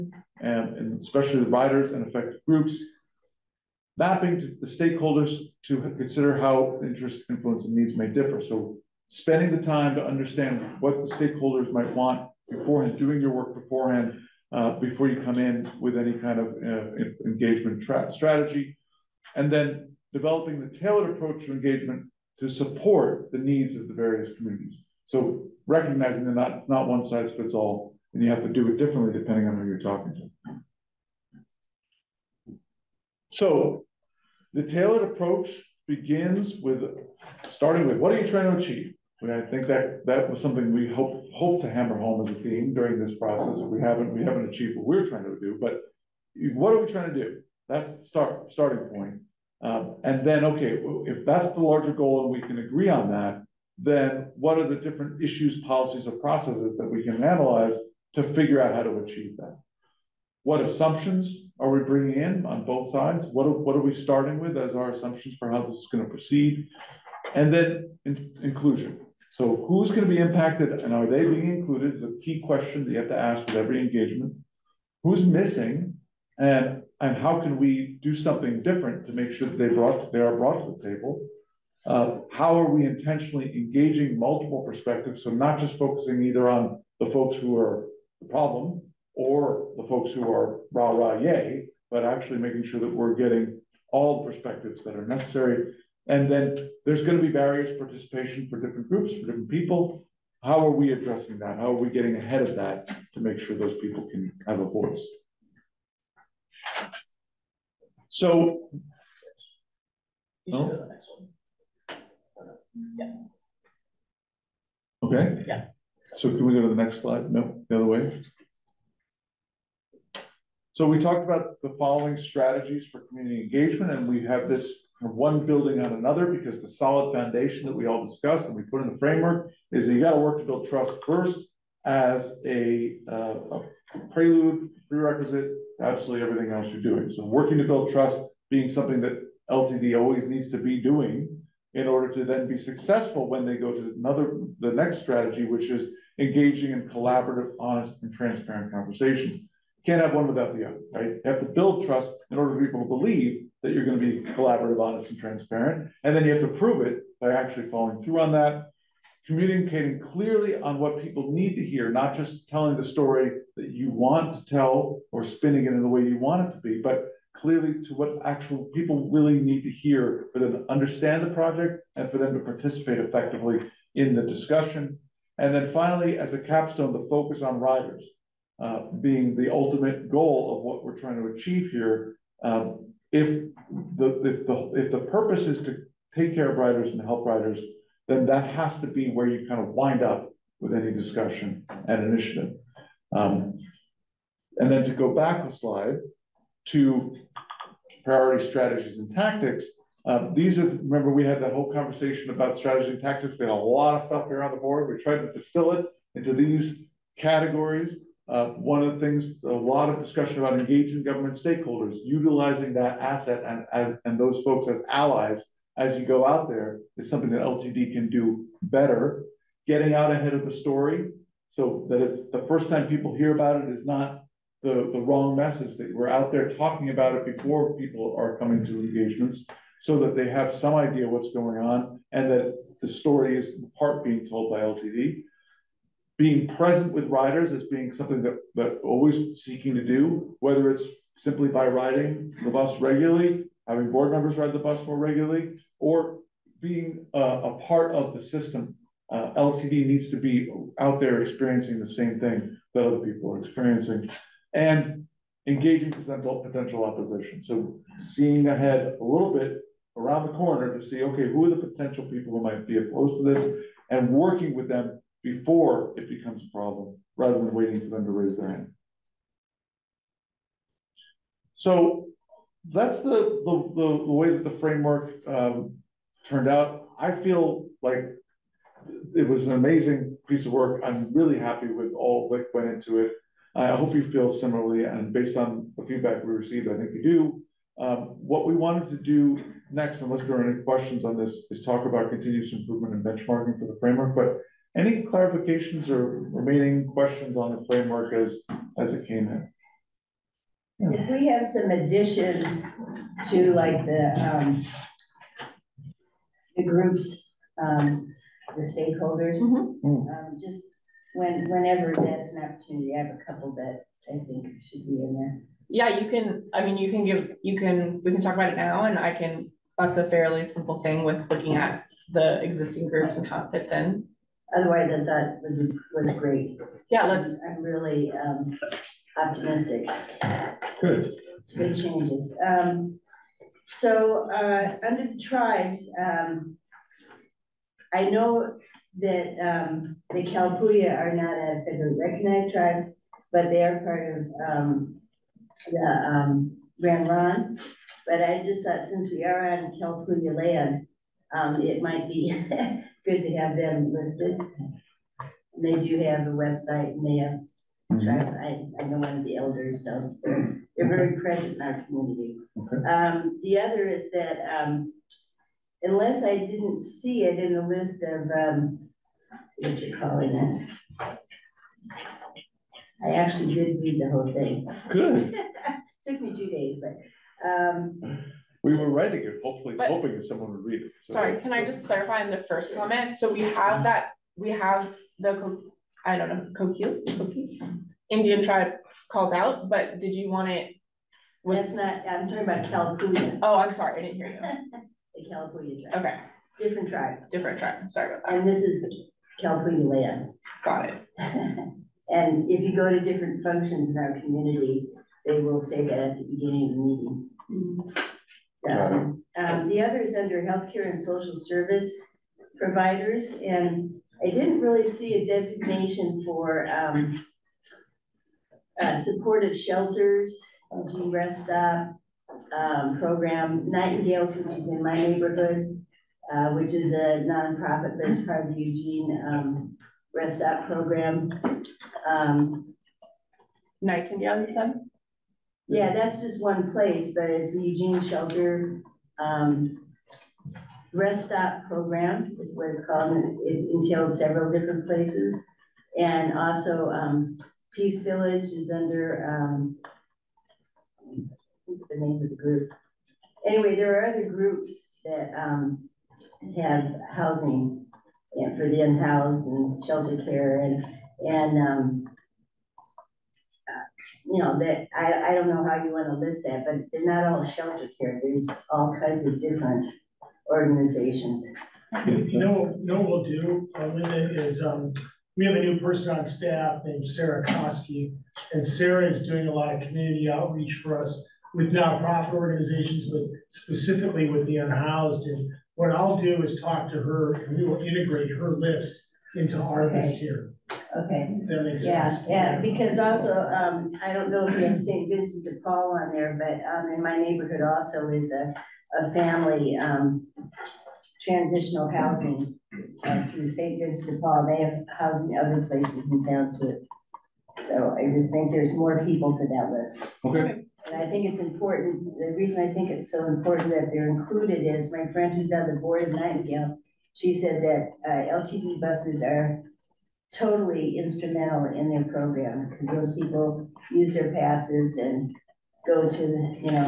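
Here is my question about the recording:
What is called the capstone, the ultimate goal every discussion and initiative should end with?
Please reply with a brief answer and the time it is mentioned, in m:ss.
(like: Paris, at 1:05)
Focus on riders, at 2:56.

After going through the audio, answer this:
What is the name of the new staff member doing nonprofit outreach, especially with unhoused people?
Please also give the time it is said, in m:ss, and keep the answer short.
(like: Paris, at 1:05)
Sarah Koski, at 7:57.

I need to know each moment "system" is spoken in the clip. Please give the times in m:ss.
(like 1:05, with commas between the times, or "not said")
4:08.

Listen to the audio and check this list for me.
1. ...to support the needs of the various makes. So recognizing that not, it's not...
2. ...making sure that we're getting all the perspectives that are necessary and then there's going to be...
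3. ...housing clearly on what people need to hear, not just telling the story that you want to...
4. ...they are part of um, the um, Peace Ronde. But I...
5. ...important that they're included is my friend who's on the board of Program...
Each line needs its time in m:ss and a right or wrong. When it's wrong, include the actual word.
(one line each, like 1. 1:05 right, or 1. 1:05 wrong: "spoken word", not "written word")
1. 0:22 wrong: "communities", not "makes"
2. 1:32 right
3. 2:39 wrong: "communicating", not "housing"
4. 5:43 wrong: "Grand", not "Peace"
5. 8:33 wrong: "Nightingale", not "Program".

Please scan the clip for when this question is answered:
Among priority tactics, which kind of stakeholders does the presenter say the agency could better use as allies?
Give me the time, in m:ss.
3:30.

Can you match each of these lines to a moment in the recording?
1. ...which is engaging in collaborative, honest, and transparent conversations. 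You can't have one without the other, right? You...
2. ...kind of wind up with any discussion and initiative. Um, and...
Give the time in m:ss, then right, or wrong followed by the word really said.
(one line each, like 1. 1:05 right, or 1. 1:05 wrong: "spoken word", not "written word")
1. 2:25 right
2. 3:09 right.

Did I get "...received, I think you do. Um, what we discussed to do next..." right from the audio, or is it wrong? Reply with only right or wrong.
wrong.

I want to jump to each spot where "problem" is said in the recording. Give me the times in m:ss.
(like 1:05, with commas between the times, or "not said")
1:28, 4:26.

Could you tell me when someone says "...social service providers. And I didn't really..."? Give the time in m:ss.
6:50.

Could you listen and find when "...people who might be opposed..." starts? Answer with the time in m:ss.
4:22.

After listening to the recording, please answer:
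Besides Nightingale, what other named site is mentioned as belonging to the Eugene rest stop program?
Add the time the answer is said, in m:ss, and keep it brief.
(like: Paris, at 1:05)
Peace Village, at 7:27.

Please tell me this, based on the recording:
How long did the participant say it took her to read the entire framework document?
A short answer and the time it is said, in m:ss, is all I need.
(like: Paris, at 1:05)
2 days, at 6:16.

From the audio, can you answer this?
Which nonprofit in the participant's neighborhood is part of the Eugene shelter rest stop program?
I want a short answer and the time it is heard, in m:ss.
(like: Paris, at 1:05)
Nightingales, at 7:03.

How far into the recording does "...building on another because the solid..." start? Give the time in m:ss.
2:05.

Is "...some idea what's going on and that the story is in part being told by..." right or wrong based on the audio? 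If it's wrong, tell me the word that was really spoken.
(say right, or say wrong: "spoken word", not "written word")
right.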